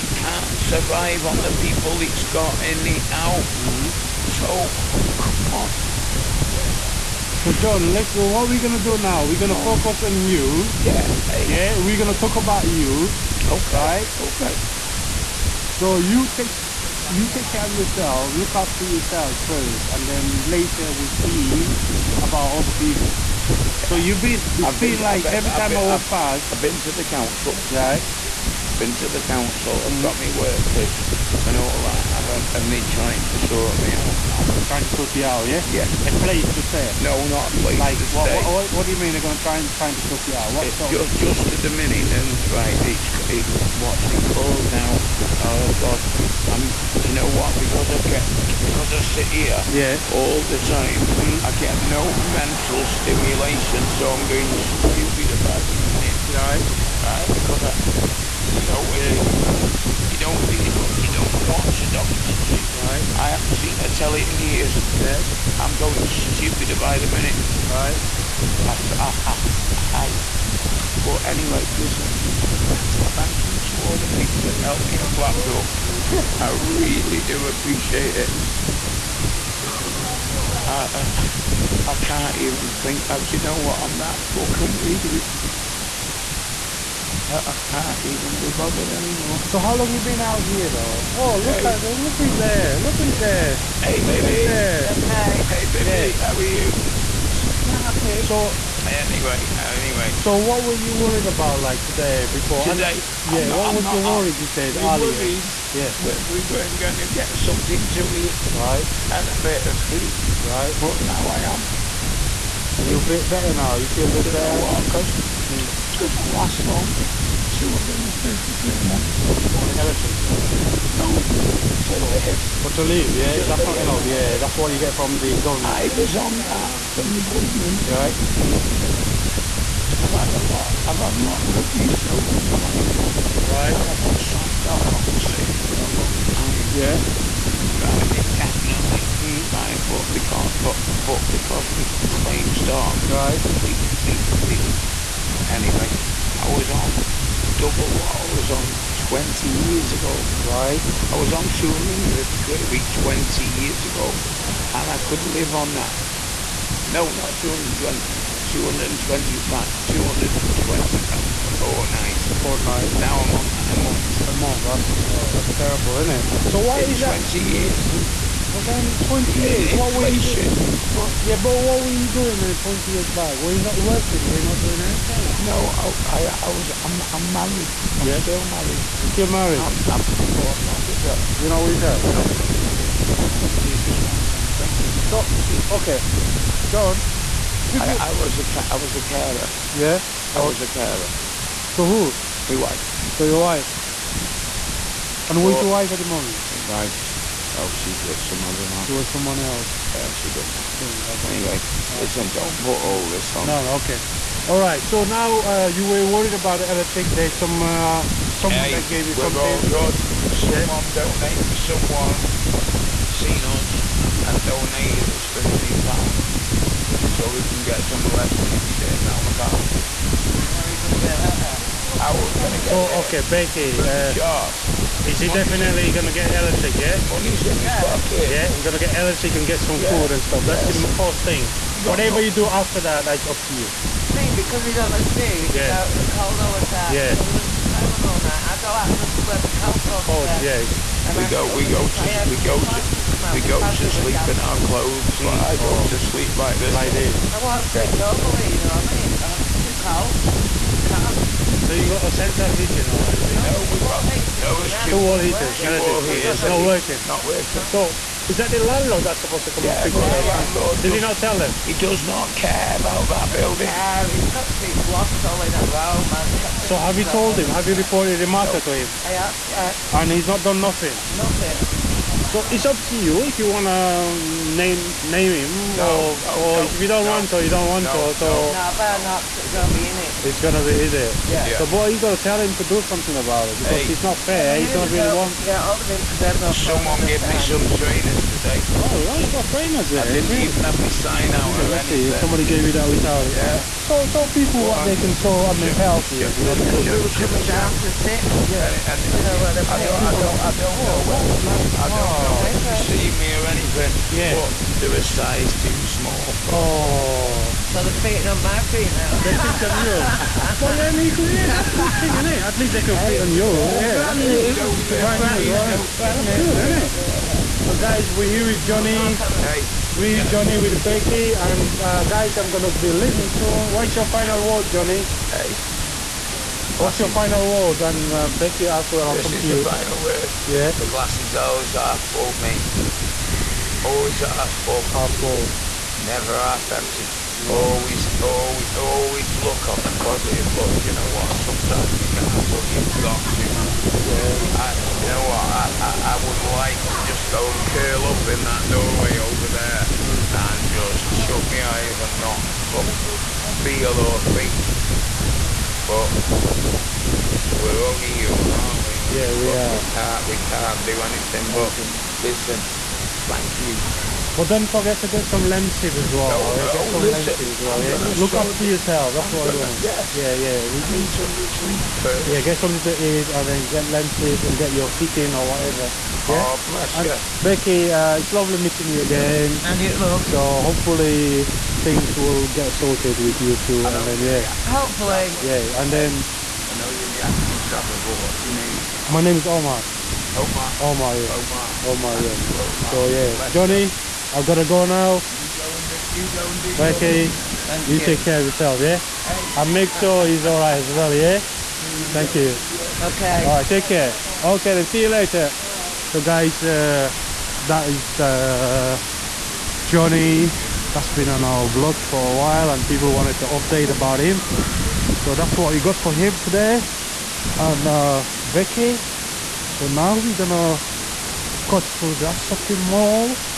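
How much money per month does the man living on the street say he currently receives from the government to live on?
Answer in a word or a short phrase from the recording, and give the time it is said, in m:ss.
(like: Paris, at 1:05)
£250, at 1:57.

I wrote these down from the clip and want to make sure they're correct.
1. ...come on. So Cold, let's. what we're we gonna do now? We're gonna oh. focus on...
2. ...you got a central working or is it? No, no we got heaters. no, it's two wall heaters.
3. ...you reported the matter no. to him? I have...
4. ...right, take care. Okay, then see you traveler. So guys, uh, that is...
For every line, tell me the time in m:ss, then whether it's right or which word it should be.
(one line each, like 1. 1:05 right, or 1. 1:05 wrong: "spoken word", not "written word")
1. 0:05 wrong: "John", not "Cold"
2. 4:11 wrong: "heating", not "working"
3. 4:27 right
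4. 6:43 wrong: "later", not "traveler".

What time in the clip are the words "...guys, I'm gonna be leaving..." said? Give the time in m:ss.
5:22.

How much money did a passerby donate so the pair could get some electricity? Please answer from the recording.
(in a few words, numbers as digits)
£15.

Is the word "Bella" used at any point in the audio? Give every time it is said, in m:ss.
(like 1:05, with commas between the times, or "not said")
not said.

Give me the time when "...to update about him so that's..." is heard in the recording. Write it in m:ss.
6:53.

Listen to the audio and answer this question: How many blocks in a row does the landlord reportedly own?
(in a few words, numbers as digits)
3.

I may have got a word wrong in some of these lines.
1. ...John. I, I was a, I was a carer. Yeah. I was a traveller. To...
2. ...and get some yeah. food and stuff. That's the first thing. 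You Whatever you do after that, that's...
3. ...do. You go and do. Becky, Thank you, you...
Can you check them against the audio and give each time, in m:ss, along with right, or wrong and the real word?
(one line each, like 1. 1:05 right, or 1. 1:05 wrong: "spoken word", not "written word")
1. 3:06 wrong: "carer", not "traveller"
2. 3:49 right
3. 6:35 right.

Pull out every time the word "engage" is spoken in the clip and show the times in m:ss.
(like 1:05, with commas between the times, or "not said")
not said.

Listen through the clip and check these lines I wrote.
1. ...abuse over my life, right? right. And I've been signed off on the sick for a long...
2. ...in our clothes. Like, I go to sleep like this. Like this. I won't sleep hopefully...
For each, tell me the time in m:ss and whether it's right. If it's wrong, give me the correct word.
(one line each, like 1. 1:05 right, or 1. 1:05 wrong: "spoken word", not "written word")
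1. 2:11 right
2. 4:04 wrong: "normally", not "hopefully".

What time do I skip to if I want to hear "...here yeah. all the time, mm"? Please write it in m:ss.
0:49.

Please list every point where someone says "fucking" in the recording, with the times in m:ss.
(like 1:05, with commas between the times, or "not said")
1:24.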